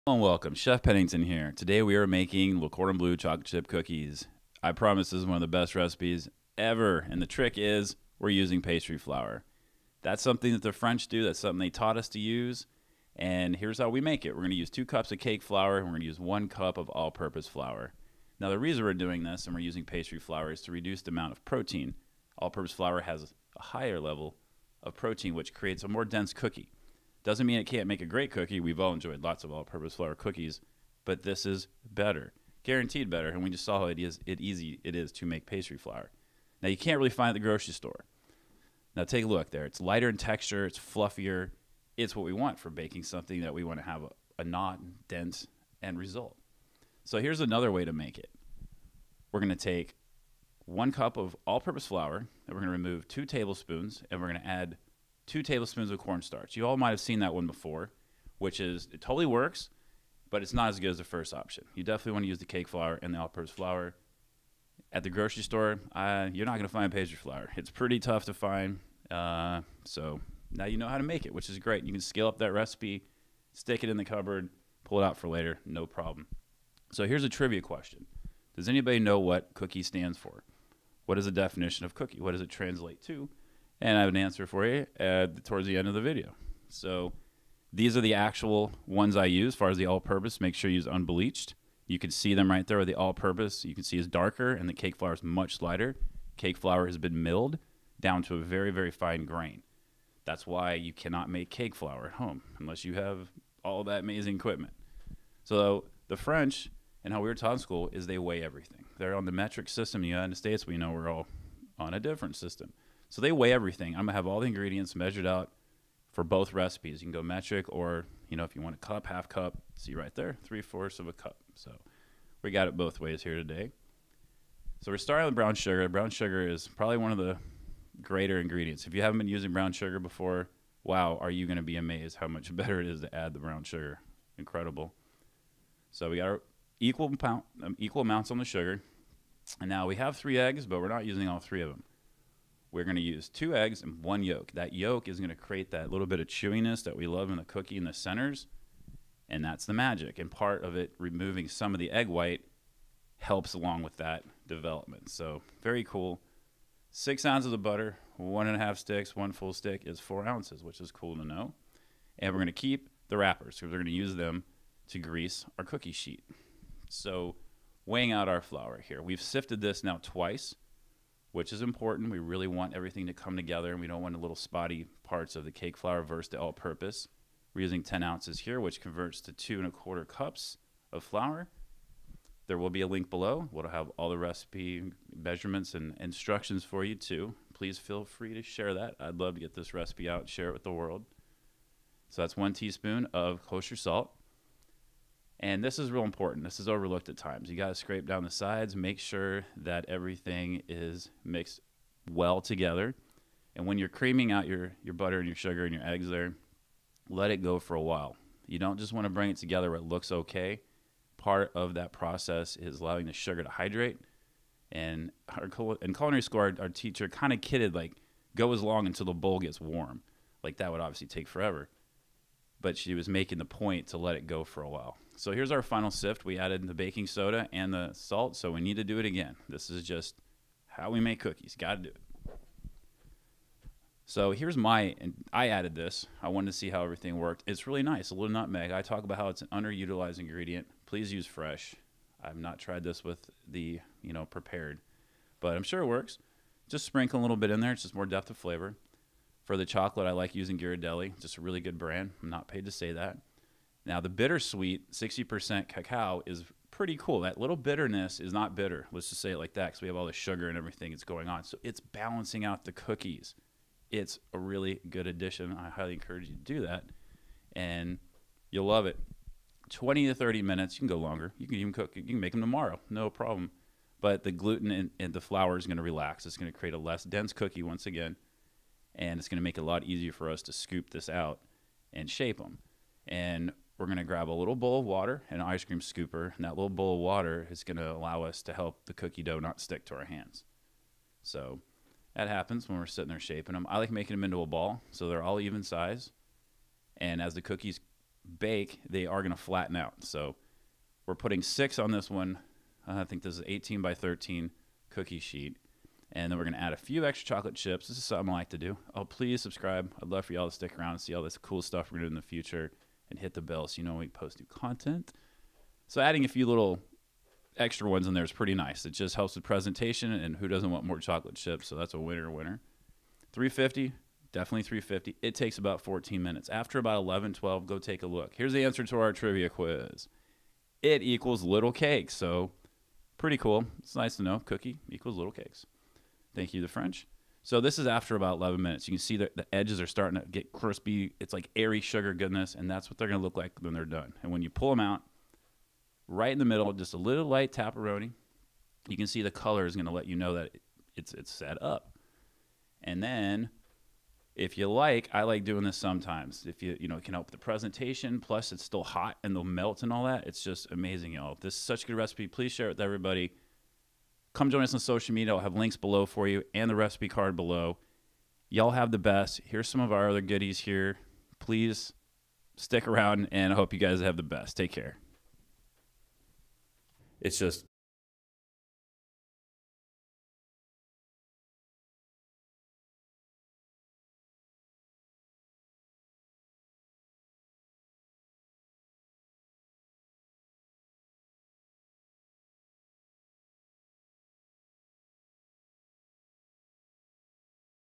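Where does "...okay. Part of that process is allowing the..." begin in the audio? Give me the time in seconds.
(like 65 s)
210 s.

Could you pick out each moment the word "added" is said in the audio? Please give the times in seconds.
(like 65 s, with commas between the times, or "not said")
226 s, 235 s.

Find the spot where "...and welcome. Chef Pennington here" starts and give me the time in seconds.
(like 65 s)
0 s.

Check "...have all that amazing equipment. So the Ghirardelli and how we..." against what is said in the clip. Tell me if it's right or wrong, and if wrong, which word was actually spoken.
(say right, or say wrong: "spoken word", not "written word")
wrong: "French", not "Ghirardelli".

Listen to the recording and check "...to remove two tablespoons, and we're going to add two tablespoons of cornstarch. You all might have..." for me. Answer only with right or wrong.
right.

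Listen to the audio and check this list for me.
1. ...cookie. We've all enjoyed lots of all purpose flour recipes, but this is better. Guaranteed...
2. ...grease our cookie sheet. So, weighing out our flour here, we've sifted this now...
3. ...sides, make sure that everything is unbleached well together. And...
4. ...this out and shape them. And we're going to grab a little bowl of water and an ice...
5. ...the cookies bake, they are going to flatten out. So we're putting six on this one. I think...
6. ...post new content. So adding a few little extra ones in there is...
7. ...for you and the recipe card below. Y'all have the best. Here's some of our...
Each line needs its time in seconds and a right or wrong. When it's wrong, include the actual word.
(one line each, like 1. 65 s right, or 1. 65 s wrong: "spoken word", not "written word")
1. 28 s wrong: "cookies", not "recipes"
2. 164 s right
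3. 198 s wrong: "mixed", not "unbleached"
4. 280 s right
5. 297 s right
6. 314 s right
7. 366 s right.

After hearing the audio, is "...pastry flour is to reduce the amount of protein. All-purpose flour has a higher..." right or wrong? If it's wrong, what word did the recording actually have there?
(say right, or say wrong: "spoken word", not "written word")
right.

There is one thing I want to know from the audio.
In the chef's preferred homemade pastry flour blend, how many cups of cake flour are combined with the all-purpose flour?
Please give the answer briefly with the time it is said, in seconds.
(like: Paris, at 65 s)
2 cups, at 14 s.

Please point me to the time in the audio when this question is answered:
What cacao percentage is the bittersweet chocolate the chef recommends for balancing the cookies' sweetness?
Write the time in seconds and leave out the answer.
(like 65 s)
254 s.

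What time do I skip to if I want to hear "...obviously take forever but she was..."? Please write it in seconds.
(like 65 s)
220 s.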